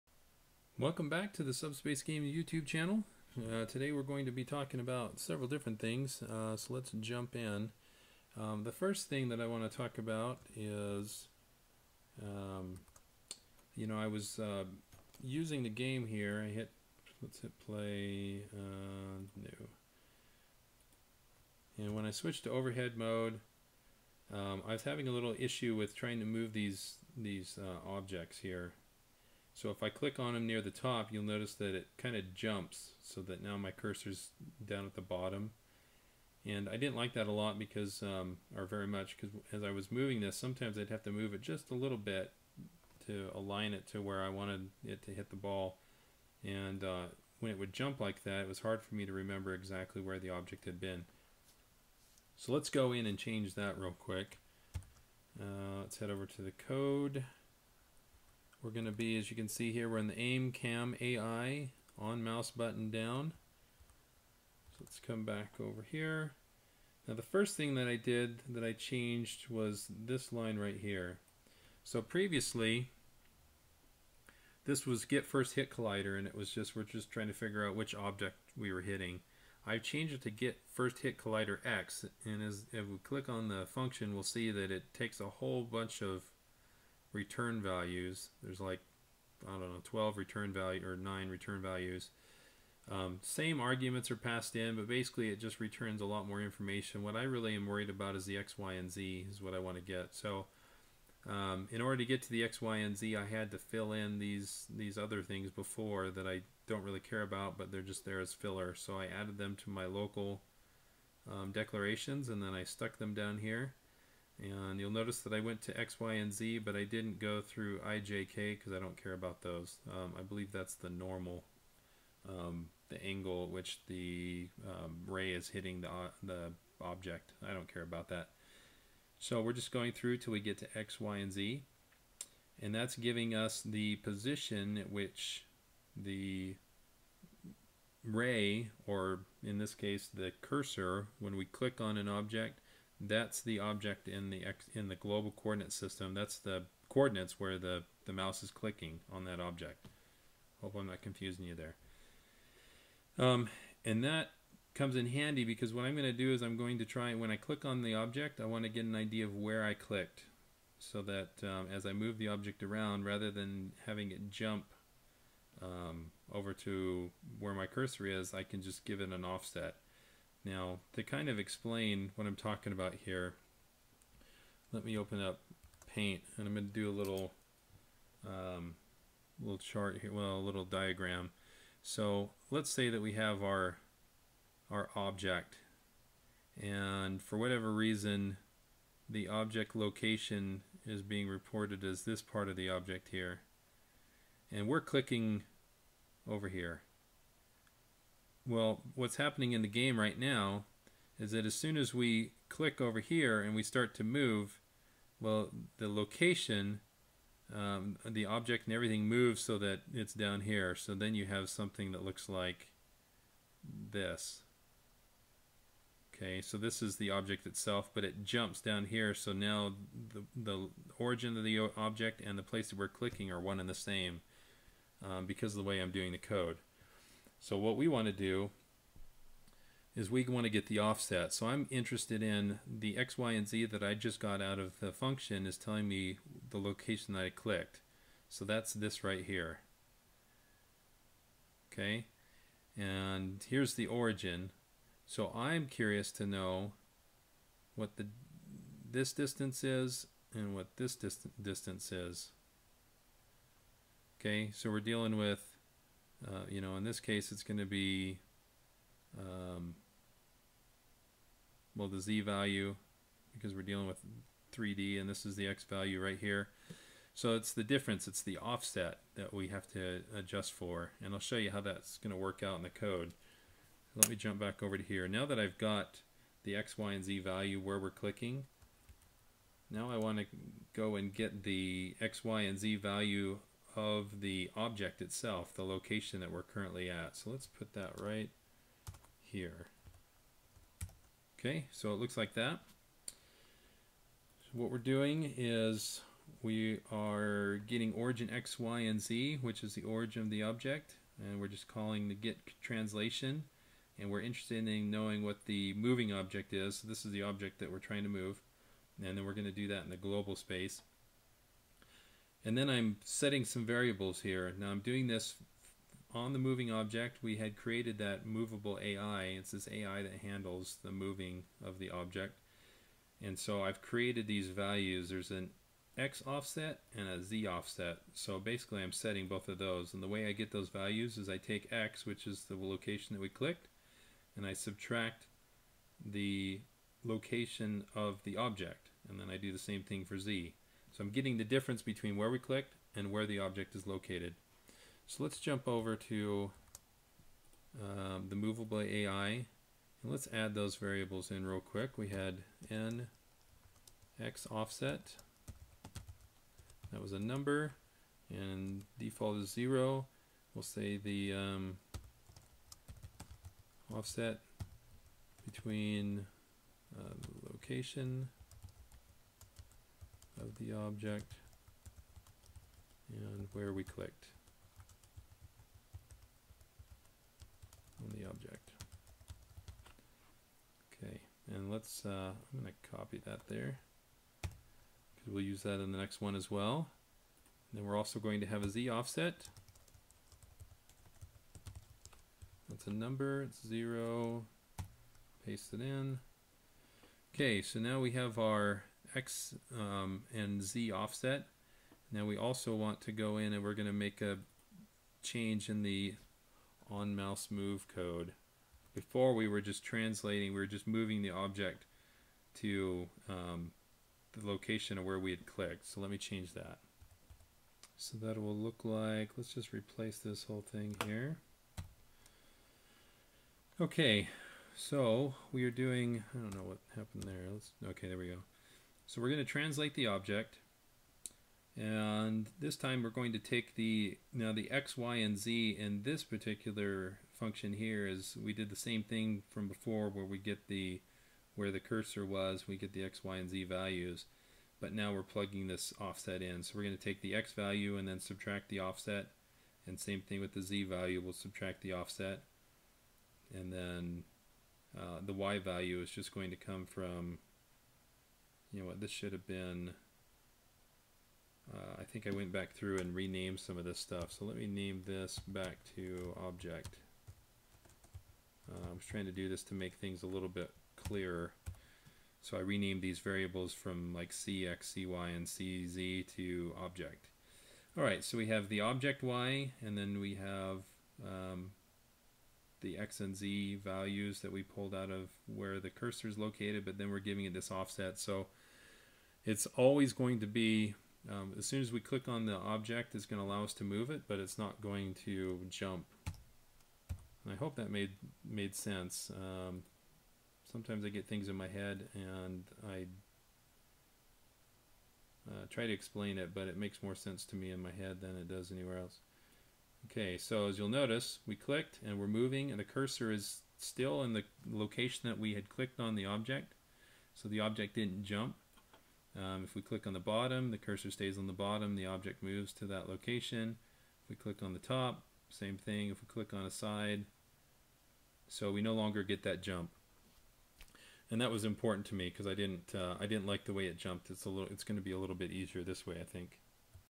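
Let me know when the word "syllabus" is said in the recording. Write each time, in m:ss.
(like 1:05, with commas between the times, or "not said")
not said.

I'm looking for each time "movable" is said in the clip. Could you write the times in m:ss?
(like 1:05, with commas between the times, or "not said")
5:18, 5:48.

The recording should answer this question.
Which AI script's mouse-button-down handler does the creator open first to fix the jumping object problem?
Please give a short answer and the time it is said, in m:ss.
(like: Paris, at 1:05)
Aim Cam AI, at 1:00.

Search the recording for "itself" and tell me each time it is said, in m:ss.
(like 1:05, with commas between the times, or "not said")
3:37, 4:45.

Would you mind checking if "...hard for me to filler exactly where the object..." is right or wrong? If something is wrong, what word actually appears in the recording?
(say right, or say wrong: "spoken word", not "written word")
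wrong: "remember", not "filler".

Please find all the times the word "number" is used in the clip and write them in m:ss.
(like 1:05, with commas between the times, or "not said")
5:57, 6:32.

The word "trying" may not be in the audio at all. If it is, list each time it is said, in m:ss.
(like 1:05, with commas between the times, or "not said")
0:25, 1:17, 5:07, 7:49.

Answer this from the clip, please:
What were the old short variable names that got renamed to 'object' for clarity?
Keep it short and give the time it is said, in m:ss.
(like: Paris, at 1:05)
CX, CY, and CZ, at 7:54.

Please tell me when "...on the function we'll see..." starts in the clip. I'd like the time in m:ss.
1:23.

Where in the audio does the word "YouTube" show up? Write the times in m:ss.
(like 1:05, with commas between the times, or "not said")
0:02.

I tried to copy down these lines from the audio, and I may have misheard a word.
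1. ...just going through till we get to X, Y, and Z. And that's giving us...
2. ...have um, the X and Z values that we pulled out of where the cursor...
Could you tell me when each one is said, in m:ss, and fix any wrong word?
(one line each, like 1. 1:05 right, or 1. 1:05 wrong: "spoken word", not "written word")
1. 2:09 right
2. 8:00 right.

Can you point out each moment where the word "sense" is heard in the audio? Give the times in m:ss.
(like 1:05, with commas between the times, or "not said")
8:18, 8:27.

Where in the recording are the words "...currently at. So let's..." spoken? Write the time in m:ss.
4:46.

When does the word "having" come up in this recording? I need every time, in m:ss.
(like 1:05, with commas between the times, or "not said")
0:24, 2:43.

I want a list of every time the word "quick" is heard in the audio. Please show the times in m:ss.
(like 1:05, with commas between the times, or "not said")
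0:53, 5:51.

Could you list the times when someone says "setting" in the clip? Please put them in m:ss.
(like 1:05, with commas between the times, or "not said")
5:13, 5:28.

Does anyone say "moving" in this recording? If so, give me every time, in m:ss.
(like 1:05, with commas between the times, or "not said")
0:39, 5:05, 5:16, 5:20, 6:50, 8:32.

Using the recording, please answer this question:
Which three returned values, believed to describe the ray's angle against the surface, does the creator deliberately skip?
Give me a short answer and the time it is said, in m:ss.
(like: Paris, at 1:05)
I, J, K, at 1:57.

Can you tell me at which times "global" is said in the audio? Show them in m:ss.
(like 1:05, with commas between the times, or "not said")
2:24, 5:09.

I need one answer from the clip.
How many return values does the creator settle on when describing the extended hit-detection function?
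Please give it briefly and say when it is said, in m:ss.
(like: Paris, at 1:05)
9, at 1:30.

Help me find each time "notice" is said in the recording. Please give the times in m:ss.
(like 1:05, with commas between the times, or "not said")
0:31, 1:54, 8:30.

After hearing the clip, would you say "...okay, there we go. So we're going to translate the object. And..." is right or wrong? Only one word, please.
right.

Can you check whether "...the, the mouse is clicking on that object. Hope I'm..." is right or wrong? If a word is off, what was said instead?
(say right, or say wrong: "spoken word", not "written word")
right.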